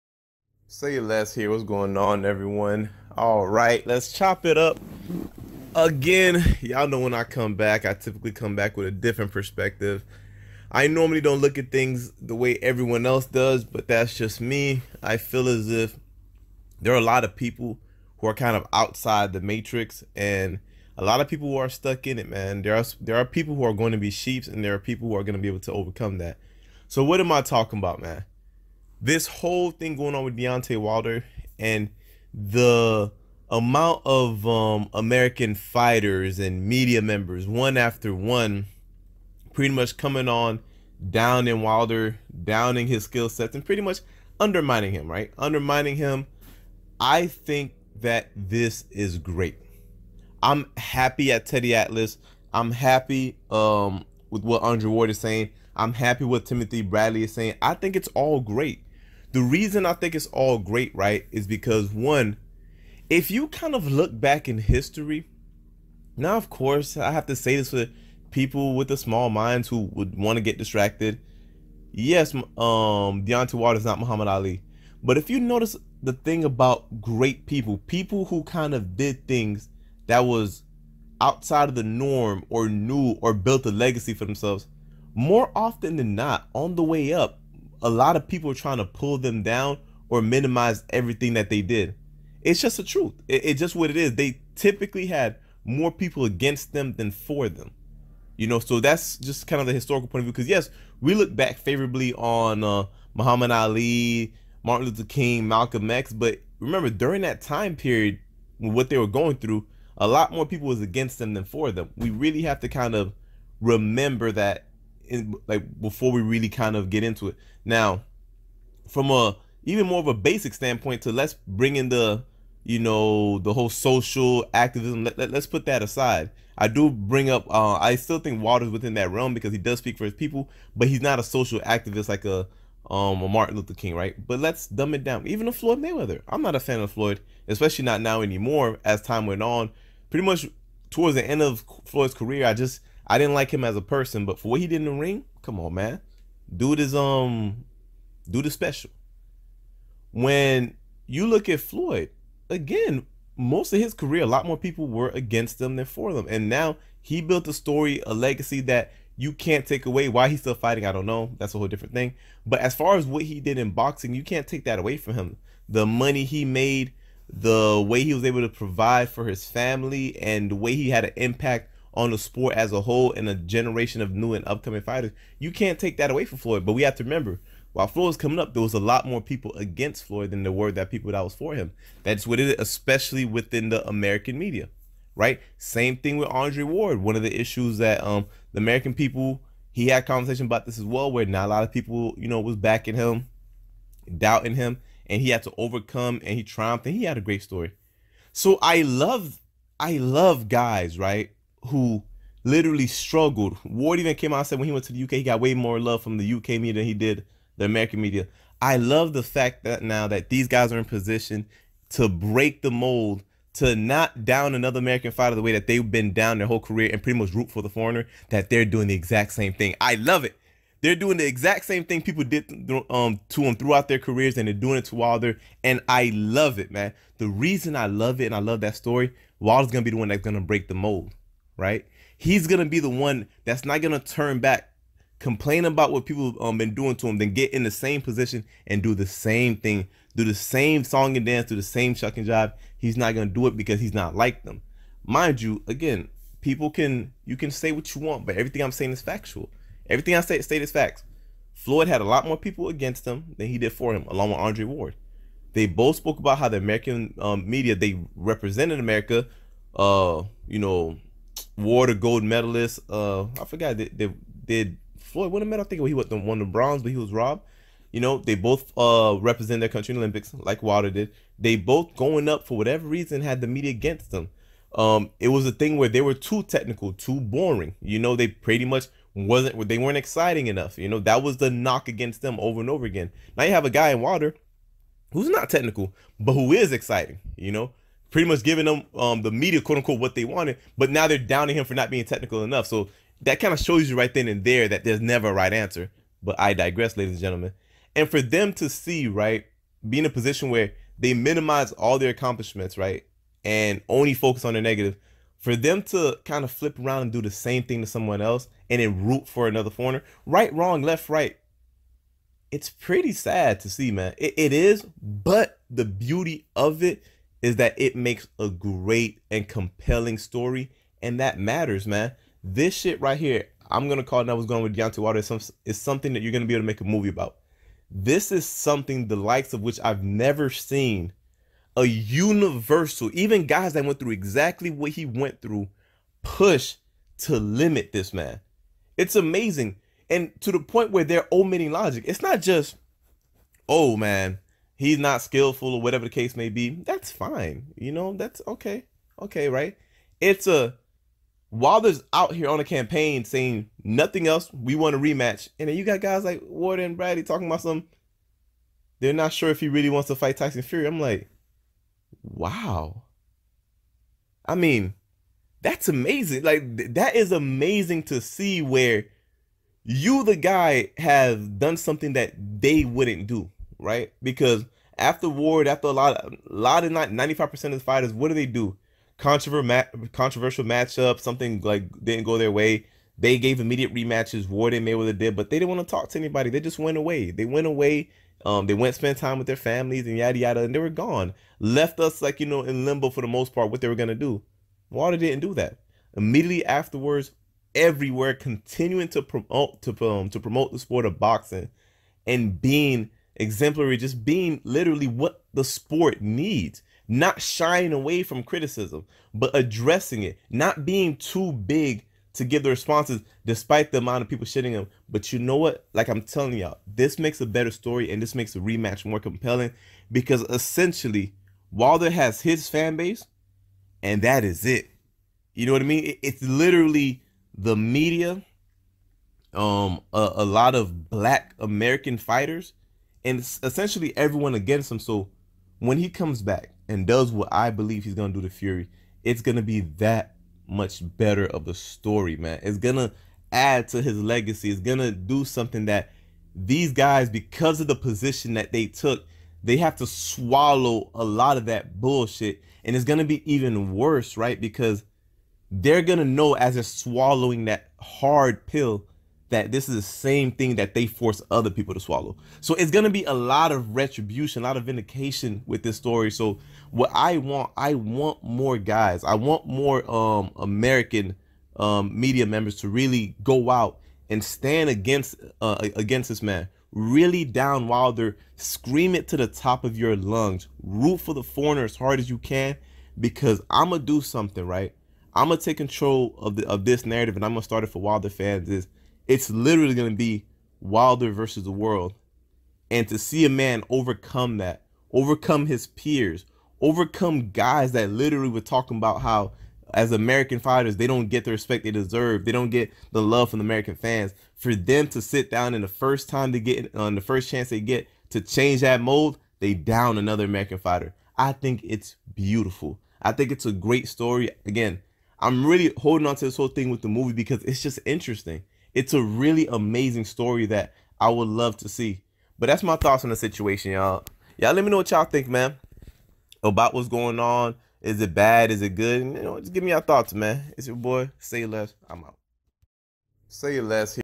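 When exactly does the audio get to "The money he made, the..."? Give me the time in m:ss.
2:45.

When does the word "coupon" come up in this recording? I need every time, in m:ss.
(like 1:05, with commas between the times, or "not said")
not said.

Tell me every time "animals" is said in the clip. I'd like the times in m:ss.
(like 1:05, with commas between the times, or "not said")
not said.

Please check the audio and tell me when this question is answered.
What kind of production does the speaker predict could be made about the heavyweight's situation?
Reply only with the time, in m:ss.
5:26.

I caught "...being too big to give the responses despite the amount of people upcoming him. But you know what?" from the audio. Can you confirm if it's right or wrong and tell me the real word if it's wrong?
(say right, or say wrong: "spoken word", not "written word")
wrong: "shitting", not "upcoming".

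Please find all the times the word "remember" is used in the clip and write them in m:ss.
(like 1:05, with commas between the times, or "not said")
1:46, 1:53, 2:57.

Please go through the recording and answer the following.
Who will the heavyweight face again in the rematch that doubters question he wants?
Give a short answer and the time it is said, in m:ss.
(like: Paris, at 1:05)
Tyson Fury, at 6:00.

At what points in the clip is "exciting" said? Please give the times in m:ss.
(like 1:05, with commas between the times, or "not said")
4:39, 4:46.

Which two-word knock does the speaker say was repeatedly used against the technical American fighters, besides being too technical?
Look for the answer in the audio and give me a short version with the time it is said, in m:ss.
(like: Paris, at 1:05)
Too boring, at 4:36.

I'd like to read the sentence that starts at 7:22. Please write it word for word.
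It's gonna add to his legacy.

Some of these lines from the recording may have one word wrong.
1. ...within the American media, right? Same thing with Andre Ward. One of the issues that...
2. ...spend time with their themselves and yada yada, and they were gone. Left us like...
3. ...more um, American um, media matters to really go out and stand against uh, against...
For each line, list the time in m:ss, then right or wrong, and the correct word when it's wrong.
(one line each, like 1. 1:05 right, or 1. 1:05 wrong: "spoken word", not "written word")
1. 3:03 right
2. 6:28 wrong: "families", not "themselves"
3. 7:49 wrong: "members", not "matters".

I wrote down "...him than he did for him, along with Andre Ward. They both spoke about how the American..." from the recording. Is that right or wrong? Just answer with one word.
right.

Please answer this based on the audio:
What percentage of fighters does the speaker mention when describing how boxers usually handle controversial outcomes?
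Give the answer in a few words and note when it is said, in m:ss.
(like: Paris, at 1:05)
95, at 6:17.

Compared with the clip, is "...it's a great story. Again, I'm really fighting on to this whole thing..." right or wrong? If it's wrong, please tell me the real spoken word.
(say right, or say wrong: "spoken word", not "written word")
wrong: "holding", not "fighting".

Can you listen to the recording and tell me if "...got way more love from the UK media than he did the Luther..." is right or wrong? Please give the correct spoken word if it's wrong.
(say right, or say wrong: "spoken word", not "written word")
wrong: "American", not "Luther".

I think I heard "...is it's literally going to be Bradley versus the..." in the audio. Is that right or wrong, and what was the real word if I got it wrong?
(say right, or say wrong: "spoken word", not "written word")
wrong: "Wilder", not "Bradley".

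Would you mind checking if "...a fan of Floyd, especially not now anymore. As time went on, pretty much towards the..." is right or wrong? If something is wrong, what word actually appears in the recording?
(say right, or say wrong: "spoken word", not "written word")
right.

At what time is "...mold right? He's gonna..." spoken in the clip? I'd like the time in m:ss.
3:50.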